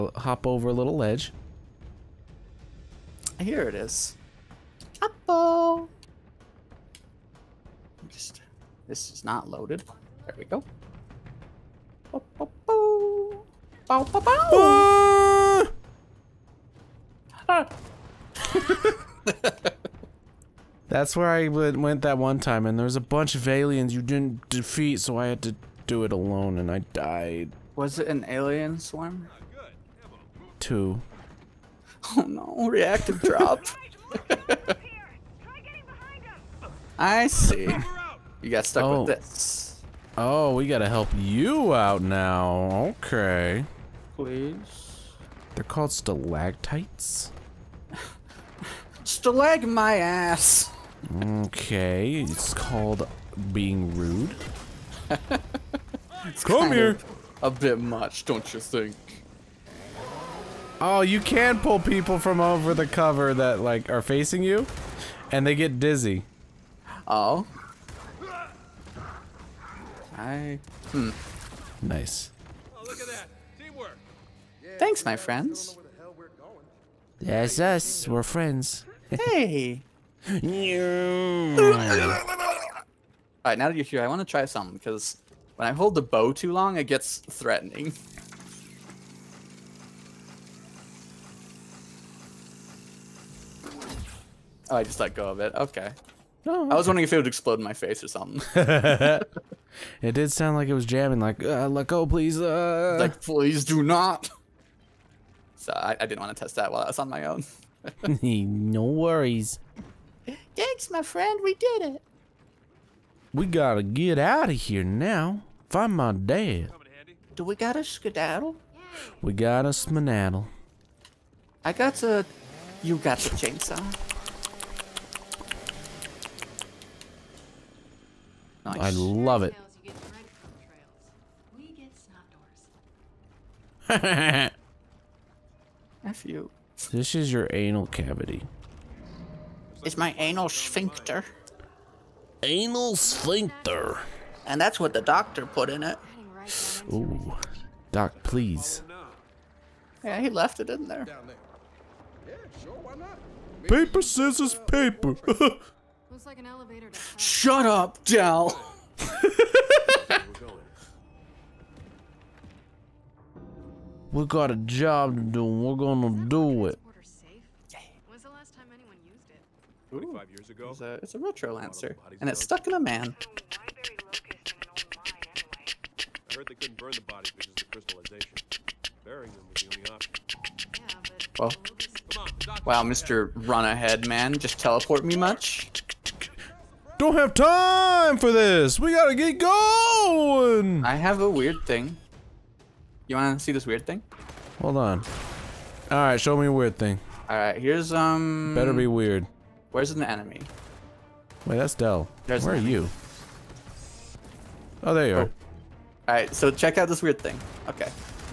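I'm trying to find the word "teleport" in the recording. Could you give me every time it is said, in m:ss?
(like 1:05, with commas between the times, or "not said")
3:04.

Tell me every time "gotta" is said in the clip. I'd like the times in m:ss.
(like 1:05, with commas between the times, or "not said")
0:40, 1:53, 3:08.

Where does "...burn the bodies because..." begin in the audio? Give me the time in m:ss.
2:56.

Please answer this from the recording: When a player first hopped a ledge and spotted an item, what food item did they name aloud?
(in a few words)
Apple.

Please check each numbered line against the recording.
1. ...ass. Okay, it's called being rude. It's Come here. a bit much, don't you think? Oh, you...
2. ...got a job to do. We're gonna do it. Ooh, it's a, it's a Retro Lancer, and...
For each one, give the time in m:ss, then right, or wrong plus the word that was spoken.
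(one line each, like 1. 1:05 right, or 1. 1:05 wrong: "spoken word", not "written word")
1. 0:49 right
2. 2:44 right.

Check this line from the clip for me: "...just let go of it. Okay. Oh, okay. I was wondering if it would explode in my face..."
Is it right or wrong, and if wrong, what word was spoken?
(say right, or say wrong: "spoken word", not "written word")
right.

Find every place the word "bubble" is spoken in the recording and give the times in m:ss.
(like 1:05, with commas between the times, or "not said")
not said.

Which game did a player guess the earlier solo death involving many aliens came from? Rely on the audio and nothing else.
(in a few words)
Alien Swarm.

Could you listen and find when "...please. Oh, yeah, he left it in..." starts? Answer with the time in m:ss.
2:28.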